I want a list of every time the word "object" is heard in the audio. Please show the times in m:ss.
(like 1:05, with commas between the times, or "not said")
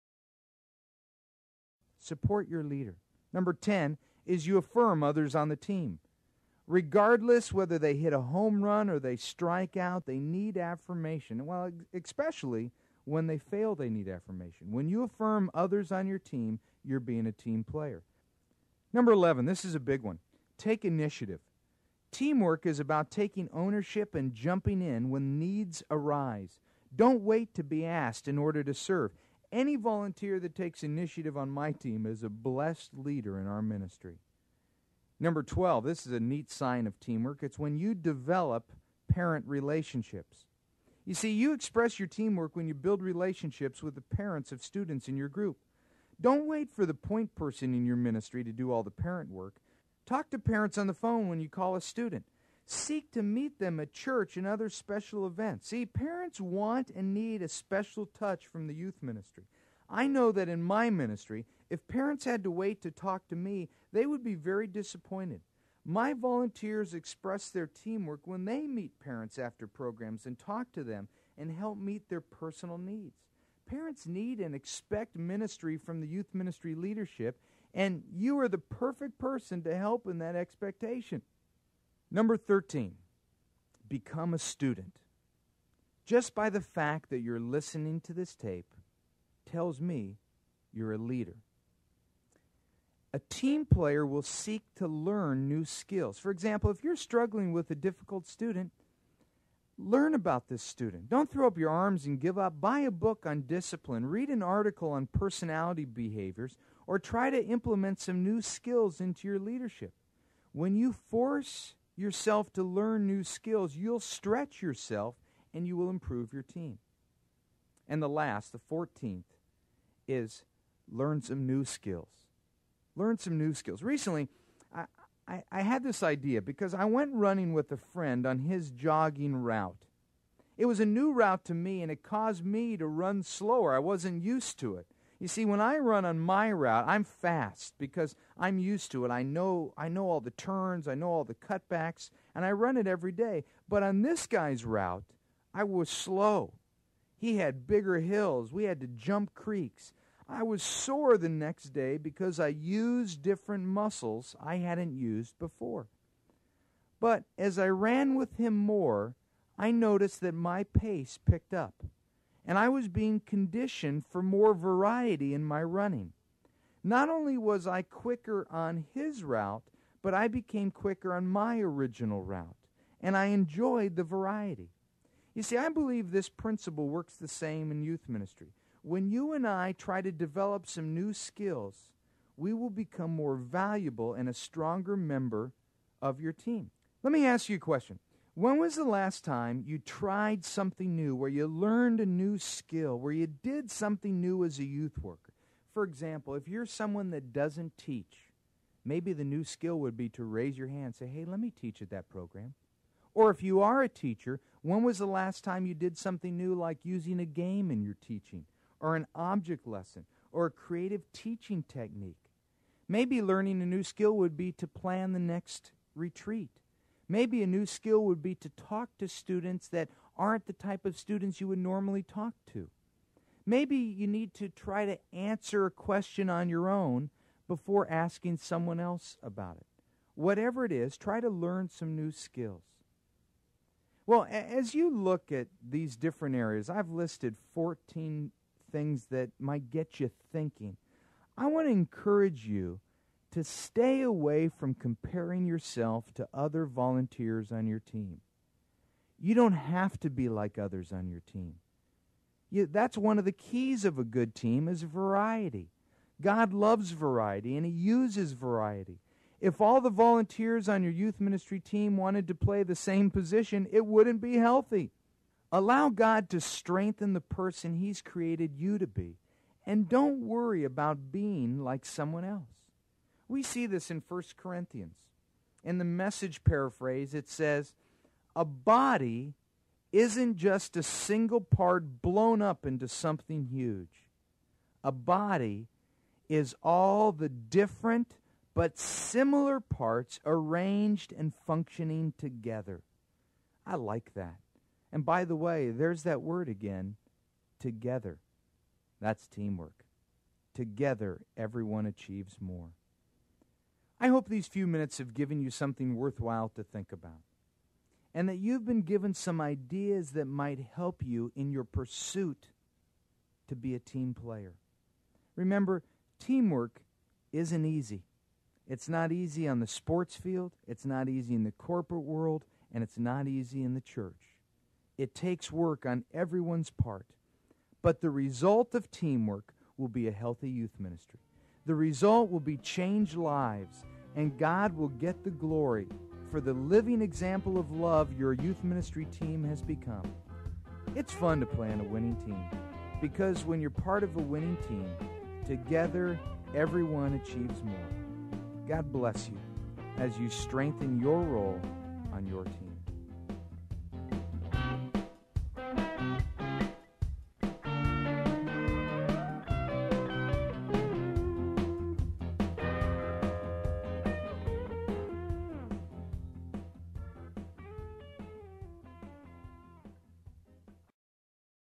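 3:29.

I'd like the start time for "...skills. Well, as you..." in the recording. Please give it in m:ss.
3:52.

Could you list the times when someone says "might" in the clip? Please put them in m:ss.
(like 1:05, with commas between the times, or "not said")
3:59, 5:10.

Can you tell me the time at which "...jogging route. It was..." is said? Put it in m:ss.
2:08.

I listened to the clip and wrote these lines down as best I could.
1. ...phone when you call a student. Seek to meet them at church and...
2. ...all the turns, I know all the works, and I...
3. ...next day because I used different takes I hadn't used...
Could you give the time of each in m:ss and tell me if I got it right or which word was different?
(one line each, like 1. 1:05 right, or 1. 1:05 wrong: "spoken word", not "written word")
1. 0:50 right
2. 2:20 wrong: "cutbacks", not "works"
3. 2:31 wrong: "muscles", not "takes".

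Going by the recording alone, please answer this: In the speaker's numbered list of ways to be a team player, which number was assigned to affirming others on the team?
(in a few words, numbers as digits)
10.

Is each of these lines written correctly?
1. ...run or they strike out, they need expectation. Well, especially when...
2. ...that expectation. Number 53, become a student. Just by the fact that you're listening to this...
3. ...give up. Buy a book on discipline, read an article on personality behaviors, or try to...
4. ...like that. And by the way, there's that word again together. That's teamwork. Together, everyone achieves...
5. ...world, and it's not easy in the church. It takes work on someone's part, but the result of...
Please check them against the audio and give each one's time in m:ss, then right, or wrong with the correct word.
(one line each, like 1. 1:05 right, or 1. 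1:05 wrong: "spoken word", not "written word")
1. 0:08 wrong: "affirmation", not "expectation"
2. 1:20 wrong: "13", not "53"
3. 1:42 right
4. 4:53 right
5. 5:22 wrong: "everyone", not "someone".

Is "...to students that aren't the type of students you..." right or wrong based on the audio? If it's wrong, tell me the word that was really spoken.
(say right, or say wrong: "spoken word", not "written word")
right.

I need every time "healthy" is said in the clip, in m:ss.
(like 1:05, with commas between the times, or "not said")
4:24, 5:30.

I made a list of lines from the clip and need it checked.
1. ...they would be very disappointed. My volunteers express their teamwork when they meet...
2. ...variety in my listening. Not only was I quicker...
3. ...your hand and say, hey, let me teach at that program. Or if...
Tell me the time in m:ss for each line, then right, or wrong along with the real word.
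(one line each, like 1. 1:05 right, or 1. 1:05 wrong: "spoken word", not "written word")
1. 1:03 right
2. 2:44 wrong: "running", not "listening"
3. 3:20 right.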